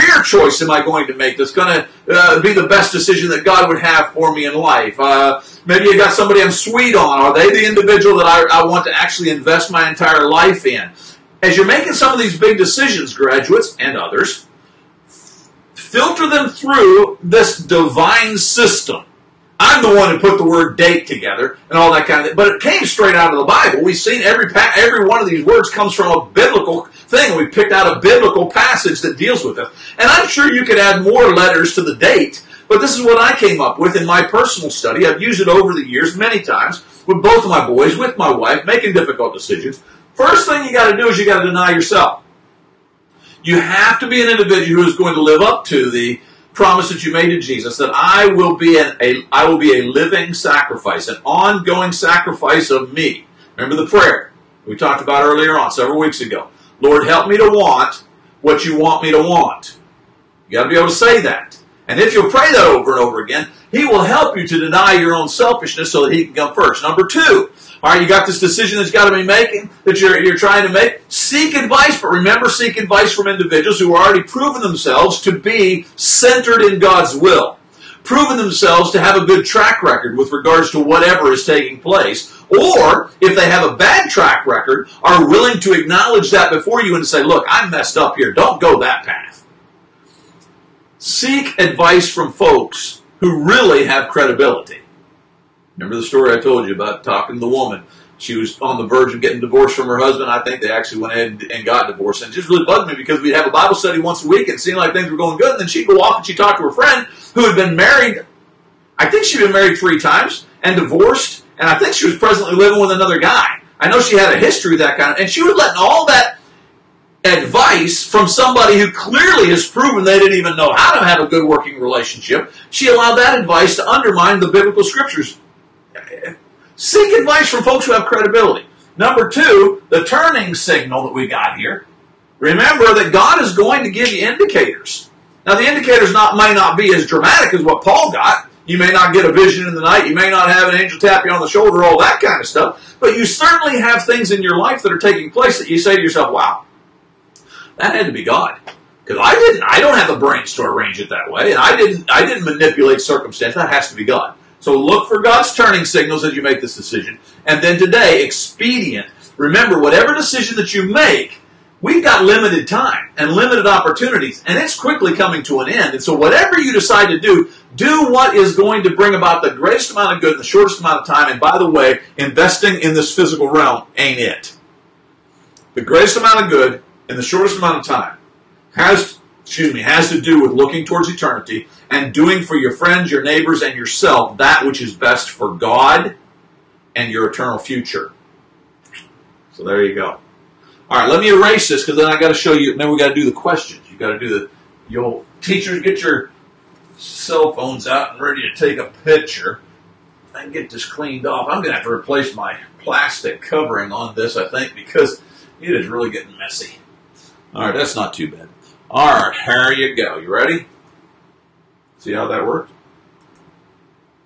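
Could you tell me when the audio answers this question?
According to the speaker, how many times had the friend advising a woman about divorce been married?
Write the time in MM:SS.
01:49.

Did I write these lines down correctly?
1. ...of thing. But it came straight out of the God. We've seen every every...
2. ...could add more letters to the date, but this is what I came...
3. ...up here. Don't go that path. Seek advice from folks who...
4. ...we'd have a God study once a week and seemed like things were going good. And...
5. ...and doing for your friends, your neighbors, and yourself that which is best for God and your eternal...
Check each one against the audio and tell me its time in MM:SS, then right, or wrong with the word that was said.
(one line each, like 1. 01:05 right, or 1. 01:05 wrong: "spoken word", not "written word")
1. 00:22 wrong: "Bible", not "God"
2. 00:30 right
3. 01:27 right
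4. 01:43 wrong: "Bible", not "God"
5. 03:01 right.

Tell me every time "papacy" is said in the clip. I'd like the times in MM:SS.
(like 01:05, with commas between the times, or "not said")
not said.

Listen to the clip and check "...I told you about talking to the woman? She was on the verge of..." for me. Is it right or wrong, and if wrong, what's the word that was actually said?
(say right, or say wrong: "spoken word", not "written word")
right.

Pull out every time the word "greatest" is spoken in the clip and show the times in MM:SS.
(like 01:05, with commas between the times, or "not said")
02:49, 02:55.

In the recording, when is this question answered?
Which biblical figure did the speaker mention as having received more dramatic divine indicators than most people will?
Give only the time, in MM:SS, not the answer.
02:17.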